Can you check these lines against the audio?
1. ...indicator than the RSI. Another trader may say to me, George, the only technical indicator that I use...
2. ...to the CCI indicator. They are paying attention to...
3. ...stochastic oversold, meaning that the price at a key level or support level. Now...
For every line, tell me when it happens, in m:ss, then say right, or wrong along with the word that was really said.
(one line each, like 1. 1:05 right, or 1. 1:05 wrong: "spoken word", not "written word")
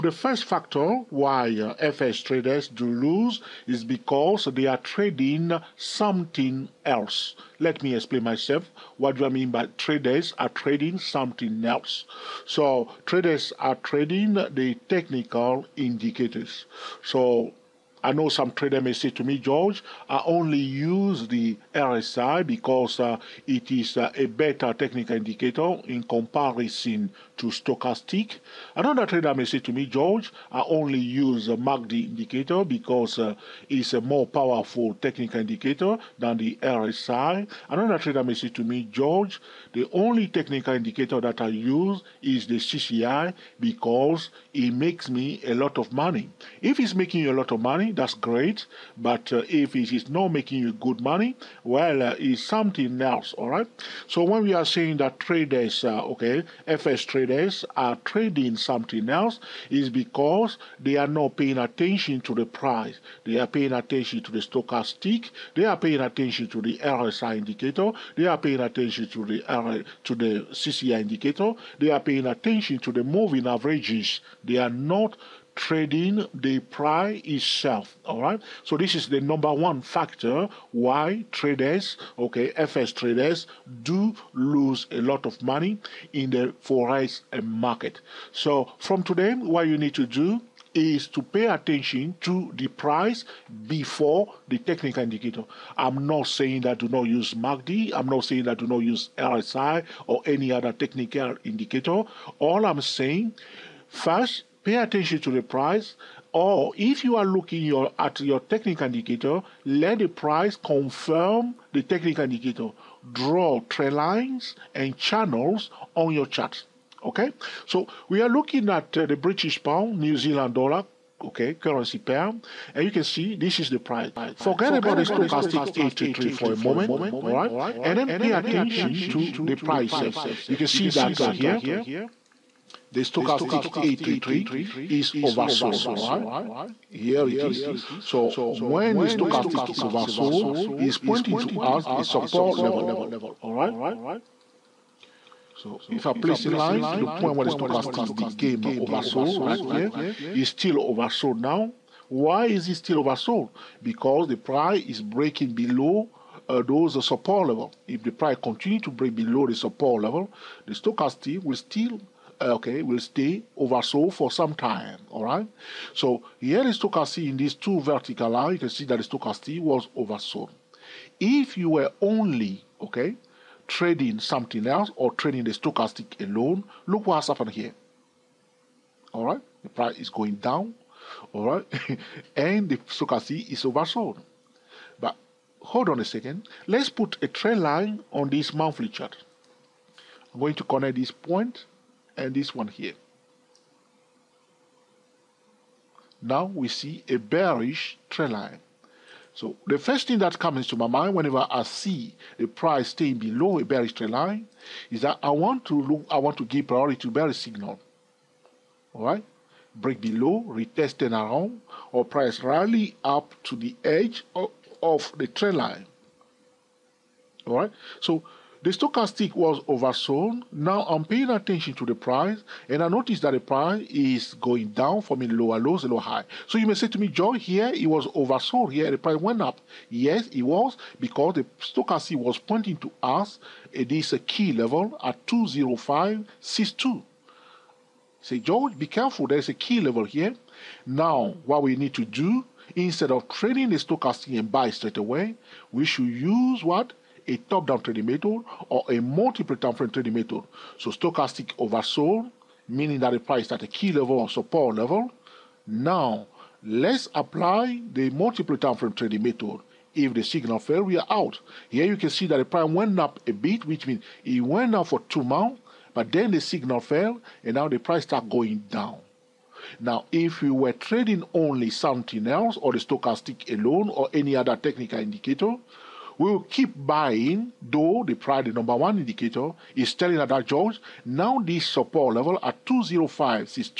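1. 0:35 right
2. 1:10 right
3. 4:10 right.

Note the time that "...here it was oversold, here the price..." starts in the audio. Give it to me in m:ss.
3:47.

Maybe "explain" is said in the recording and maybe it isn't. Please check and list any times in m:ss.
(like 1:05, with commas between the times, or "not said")
0:07.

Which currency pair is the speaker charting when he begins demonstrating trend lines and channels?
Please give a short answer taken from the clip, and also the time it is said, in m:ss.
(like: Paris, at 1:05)
British pound / New Zealand dollar, at 1:59.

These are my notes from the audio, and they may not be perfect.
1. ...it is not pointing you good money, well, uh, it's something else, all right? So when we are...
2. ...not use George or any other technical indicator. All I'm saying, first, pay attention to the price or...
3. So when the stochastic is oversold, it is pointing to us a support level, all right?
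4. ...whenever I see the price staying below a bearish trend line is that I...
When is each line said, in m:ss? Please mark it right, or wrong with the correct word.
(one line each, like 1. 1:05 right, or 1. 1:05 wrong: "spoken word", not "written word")
1. 0:49 wrong: "making", not "pointing"
2. 1:38 wrong: "RSI", not "George"
3. 2:18 right
4. 3:21 right.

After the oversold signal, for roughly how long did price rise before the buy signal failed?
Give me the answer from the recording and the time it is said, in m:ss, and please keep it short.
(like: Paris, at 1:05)
2 months, at 4:25.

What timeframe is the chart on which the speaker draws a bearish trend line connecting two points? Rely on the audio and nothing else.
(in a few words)
Monthly.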